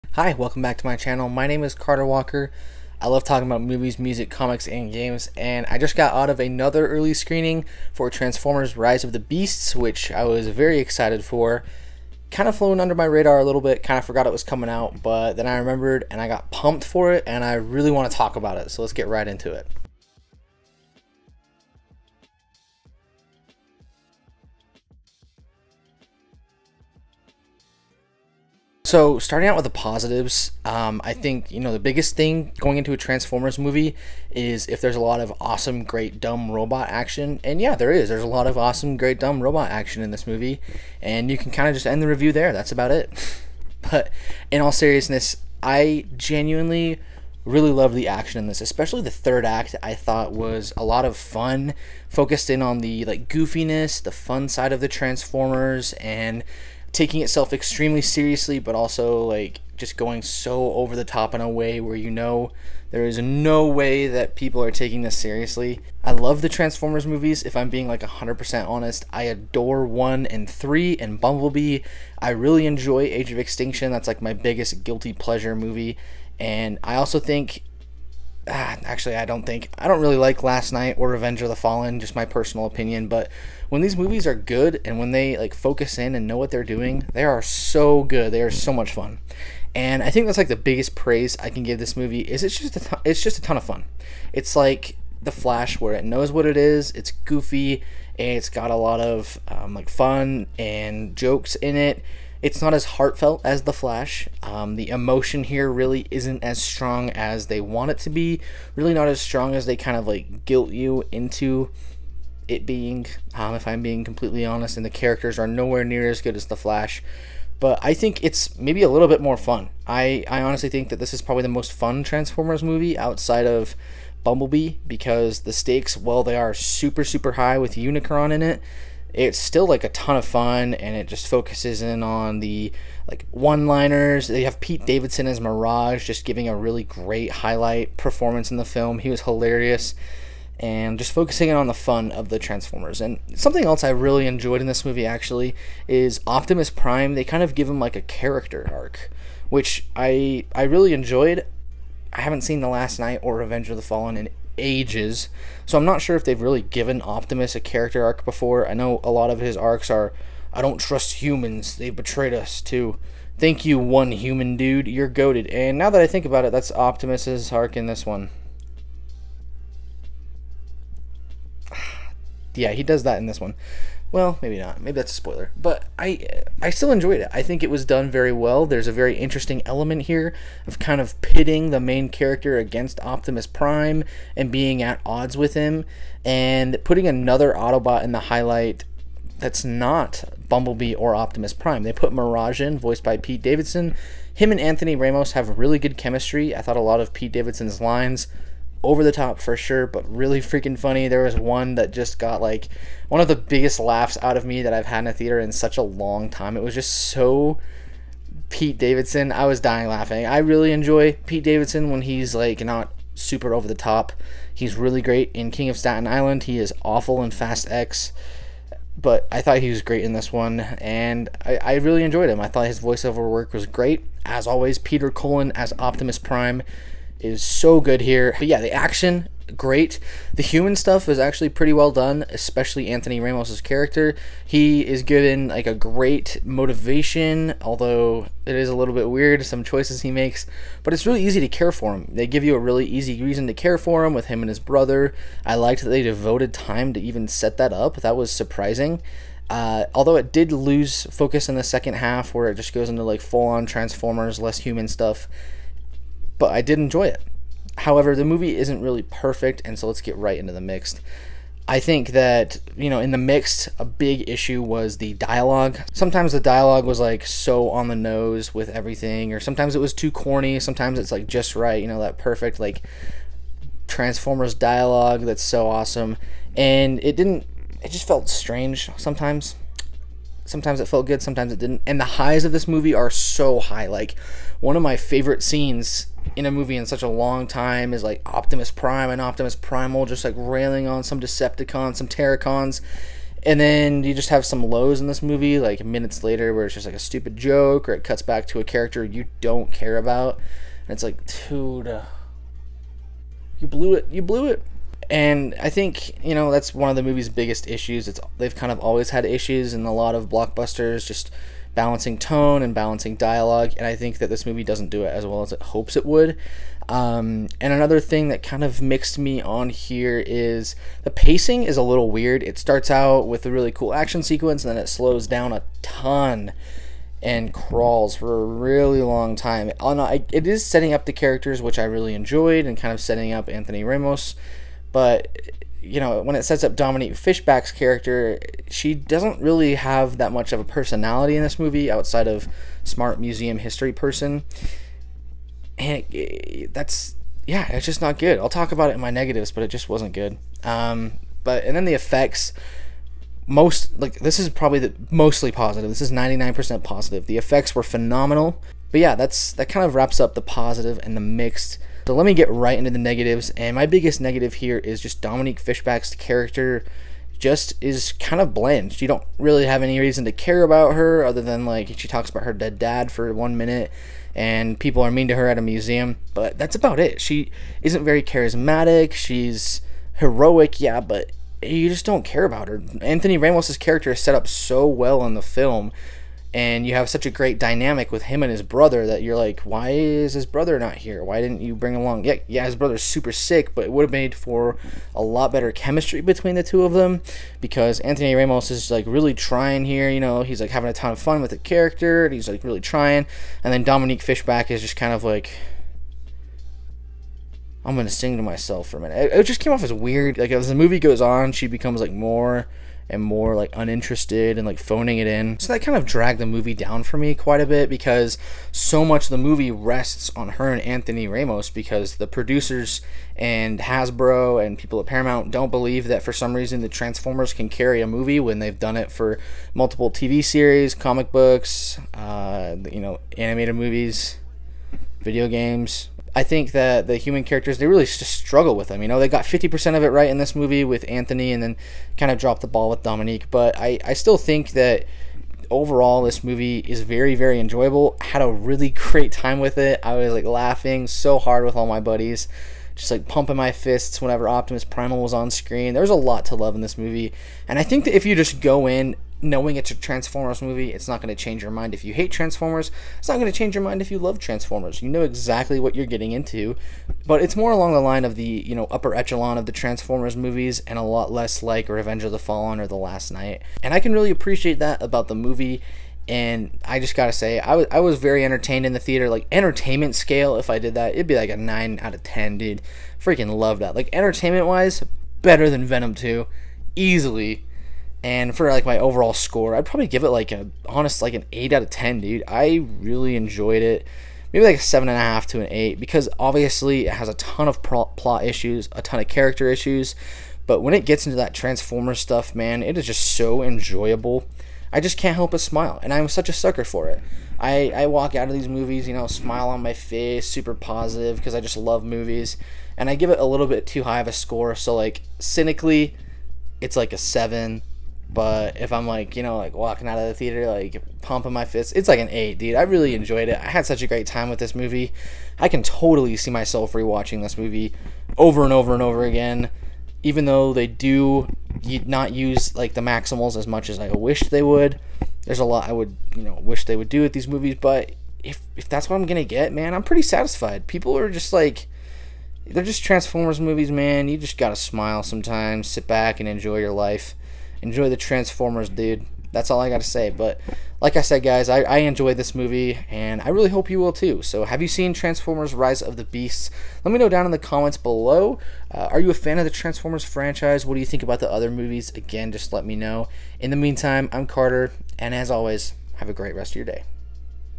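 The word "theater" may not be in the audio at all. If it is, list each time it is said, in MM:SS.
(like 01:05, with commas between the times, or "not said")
03:25, 07:58, 08:40.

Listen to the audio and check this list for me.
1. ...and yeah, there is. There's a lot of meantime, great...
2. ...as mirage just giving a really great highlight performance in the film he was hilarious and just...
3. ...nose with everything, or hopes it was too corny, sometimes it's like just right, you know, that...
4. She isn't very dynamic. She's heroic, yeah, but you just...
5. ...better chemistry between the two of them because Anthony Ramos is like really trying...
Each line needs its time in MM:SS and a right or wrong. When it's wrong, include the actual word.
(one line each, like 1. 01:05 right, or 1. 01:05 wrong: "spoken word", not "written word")
1. 00:37 wrong: "awesome", not "meantime"
2. 02:15 right
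3. 04:27 wrong: "sometimes", not "hopes"
4. 06:17 wrong: "charismatic", not "dynamic"
5. 06:35 right.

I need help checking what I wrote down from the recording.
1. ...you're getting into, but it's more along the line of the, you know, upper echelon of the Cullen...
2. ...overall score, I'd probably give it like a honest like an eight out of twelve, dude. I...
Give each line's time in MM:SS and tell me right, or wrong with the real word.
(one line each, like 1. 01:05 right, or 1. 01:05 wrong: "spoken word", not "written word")
1. 07:45 wrong: "Transformers", not "Cullen"
2. 08:08 wrong: "ten", not "twelve".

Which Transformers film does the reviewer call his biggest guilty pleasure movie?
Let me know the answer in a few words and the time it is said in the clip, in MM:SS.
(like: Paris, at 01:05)
Age of Extinction, at 01:13.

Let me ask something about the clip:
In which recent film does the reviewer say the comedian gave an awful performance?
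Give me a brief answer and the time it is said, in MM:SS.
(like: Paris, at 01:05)
Fast X, at 03:37.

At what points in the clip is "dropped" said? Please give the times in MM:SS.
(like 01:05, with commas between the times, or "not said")
07:22.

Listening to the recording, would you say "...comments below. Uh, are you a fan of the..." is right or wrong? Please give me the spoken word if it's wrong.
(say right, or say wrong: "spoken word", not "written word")
right.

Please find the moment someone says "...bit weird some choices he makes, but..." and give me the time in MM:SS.
03:58.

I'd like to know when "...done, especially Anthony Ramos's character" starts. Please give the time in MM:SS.
03:51.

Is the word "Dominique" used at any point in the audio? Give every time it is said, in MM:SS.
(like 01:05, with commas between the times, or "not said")
05:36, 06:05, 06:43, 07:23.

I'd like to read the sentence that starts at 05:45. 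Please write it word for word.
And it, it, that's, yeah, it's just not good.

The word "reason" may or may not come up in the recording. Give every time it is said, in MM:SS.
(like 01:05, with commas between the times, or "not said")
04:03, 06:09, 07:06.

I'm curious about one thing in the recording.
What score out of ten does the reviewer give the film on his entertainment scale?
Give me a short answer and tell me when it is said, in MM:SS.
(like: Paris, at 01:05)
9, at 08:01.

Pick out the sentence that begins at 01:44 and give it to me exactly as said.
Um, the emotion here really isn't as strong as they want it to be.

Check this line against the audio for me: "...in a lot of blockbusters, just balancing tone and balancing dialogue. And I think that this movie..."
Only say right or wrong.
right.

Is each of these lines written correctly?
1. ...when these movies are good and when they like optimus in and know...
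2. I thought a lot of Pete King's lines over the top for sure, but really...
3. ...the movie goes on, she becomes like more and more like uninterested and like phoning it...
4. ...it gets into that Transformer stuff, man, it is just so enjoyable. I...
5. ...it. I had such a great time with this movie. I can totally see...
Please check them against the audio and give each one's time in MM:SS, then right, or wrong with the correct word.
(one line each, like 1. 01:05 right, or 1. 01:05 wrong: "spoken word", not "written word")
1. 01:23 wrong: "focus", not "optimus"
2. 03:16 wrong: "Davidson", not "King"
3. 06:50 right
4. 08:20 right
5. 08:43 right.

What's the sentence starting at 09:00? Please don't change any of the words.
People are just like, they're just Transformers movies, man.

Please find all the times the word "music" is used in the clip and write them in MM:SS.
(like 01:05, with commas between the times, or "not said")
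00:03.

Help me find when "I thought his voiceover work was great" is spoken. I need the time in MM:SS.
03:42.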